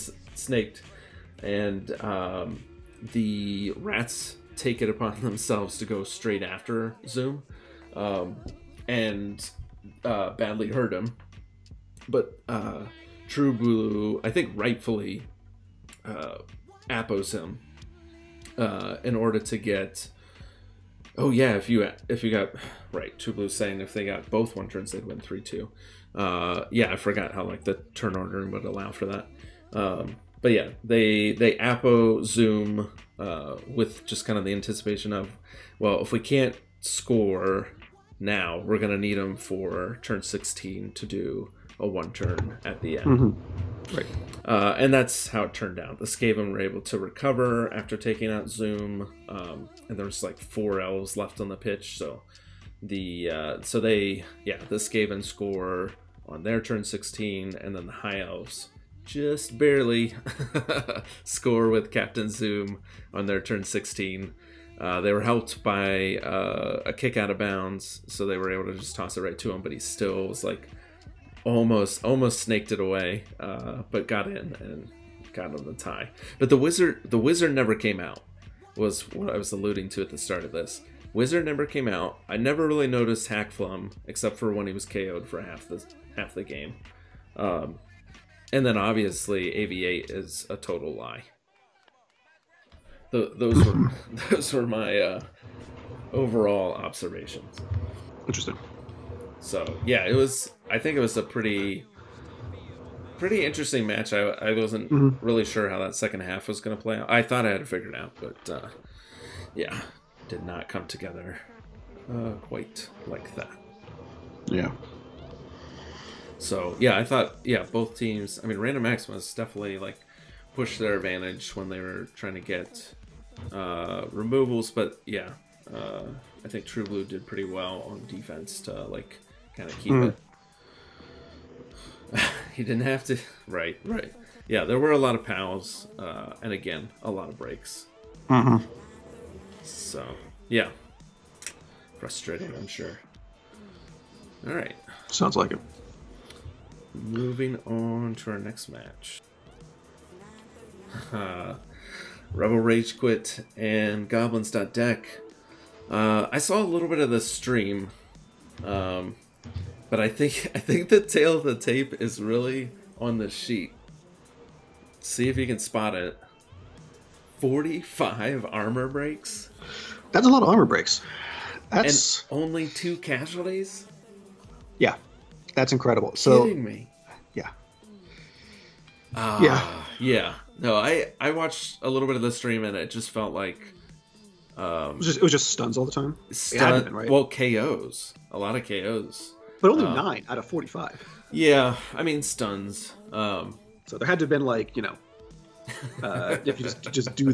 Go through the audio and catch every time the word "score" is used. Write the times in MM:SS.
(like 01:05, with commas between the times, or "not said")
00:36, 00:55, 01:01.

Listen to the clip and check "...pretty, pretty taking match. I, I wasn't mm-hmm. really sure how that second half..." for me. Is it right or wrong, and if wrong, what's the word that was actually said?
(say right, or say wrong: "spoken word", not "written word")
wrong: "interesting", not "taking".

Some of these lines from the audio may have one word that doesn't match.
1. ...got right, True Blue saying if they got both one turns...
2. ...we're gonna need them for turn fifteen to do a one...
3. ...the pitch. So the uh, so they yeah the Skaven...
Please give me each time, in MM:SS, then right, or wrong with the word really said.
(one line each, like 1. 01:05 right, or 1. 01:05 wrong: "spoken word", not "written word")
1. 00:22 right
2. 00:38 wrong: "sixteen", not "fifteen"
3. 00:51 right.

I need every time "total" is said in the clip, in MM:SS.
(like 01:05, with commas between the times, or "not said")
01:30.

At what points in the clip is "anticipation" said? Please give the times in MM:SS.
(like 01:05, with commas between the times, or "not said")
00:34.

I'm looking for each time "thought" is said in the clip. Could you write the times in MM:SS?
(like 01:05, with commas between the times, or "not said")
01:47, 01:57.